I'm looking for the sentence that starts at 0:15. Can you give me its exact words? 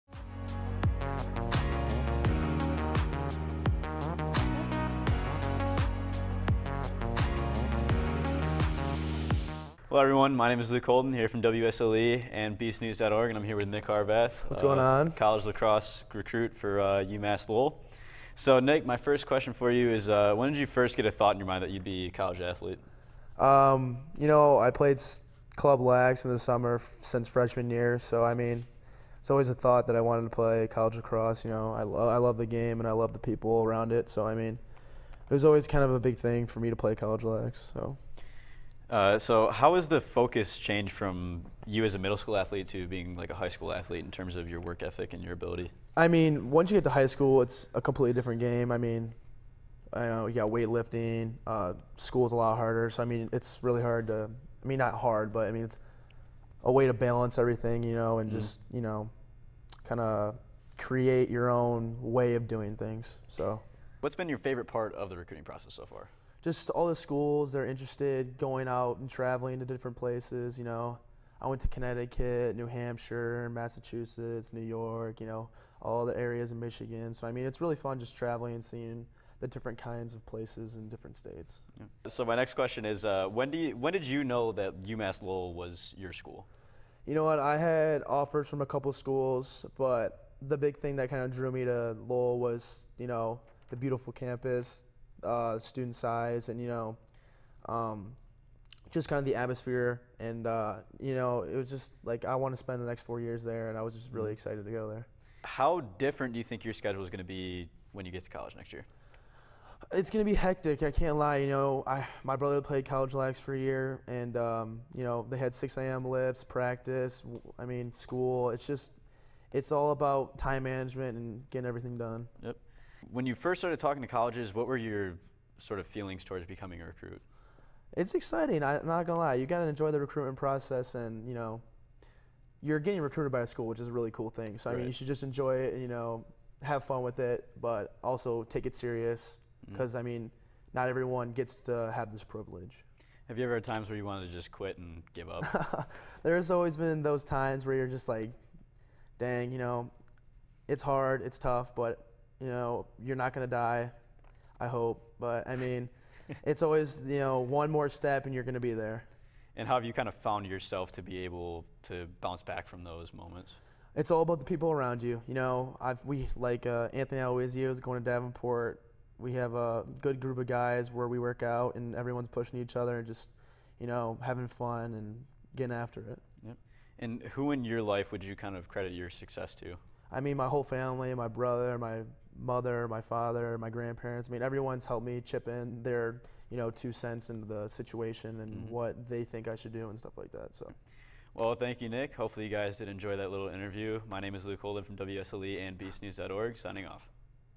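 College lacrosse recruit for uh, UMass Lowell.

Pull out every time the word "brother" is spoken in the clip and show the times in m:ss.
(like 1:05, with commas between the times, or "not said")
1:52, 3:01.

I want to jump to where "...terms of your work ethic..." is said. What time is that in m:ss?
0:44.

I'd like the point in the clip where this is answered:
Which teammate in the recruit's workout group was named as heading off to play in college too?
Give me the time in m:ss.
2:46.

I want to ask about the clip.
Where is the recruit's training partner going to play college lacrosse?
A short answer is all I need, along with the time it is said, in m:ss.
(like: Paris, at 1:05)
Davenport, at 2:48.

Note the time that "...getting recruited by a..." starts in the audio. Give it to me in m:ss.
2:12.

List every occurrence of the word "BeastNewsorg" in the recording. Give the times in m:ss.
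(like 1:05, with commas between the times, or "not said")
0:12, 3:15.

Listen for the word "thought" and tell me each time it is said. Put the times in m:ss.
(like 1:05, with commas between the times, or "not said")
0:21, 0:29.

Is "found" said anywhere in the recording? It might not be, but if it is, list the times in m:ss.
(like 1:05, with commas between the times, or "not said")
2:40.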